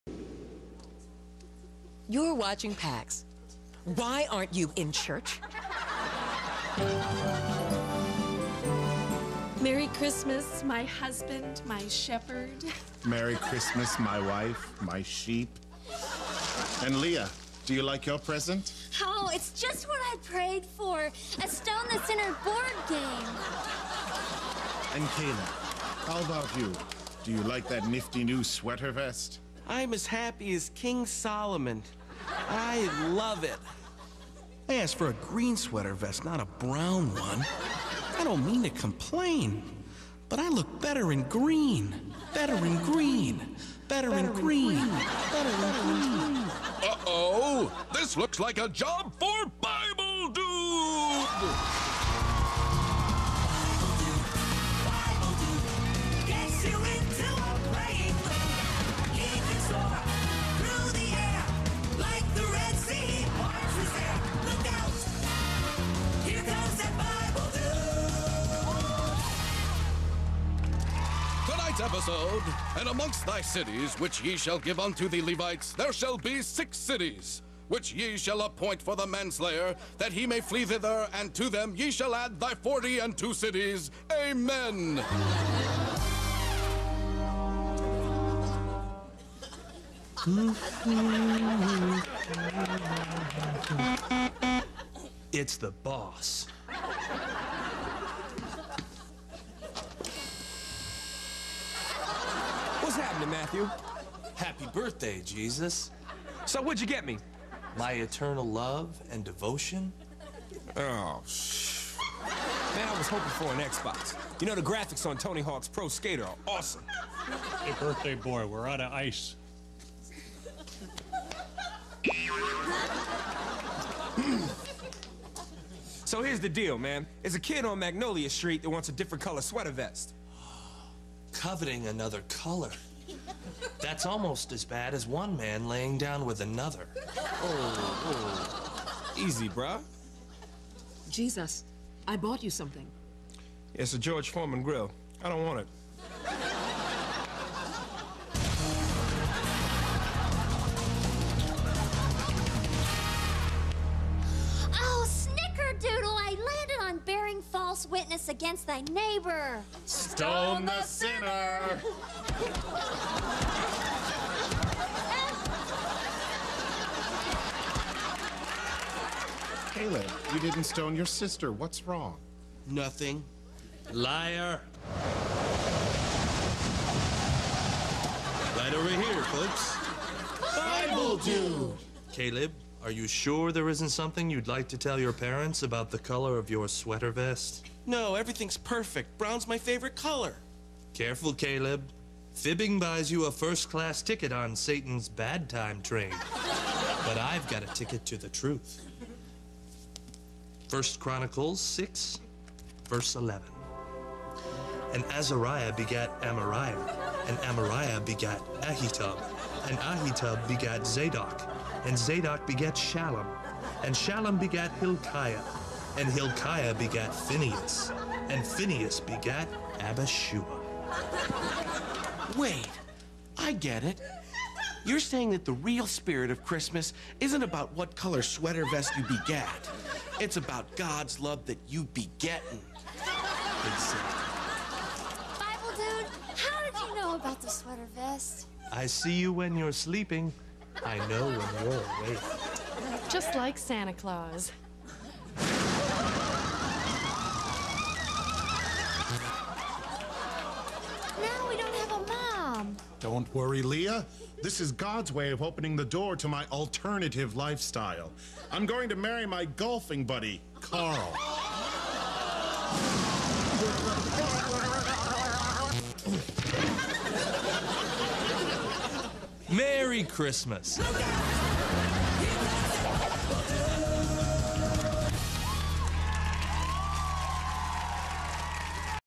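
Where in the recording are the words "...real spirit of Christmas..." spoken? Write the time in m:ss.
3:45.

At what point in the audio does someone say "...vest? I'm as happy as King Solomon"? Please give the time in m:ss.
0:28.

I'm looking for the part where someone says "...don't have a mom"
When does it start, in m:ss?
4:11.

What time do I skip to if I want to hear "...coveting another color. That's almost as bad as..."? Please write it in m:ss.
2:11.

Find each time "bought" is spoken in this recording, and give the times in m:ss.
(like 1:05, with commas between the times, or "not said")
2:22.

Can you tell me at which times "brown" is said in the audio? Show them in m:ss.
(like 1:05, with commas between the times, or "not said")
0:36, 3:09.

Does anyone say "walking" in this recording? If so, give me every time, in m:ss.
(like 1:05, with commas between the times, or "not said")
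not said.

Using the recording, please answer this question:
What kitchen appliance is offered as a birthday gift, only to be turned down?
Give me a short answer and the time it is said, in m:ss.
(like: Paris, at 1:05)
George Foreman grill, at 2:23.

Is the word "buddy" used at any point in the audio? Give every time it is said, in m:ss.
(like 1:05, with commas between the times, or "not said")
4:20.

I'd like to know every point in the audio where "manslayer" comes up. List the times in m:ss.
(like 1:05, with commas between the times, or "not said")
1:19.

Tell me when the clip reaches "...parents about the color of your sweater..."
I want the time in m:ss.
3:05.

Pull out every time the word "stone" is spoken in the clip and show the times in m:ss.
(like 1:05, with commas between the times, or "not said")
0:21, 2:39, 2:50.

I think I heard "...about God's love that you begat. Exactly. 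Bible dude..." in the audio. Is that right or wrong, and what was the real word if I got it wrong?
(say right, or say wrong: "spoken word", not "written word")
right.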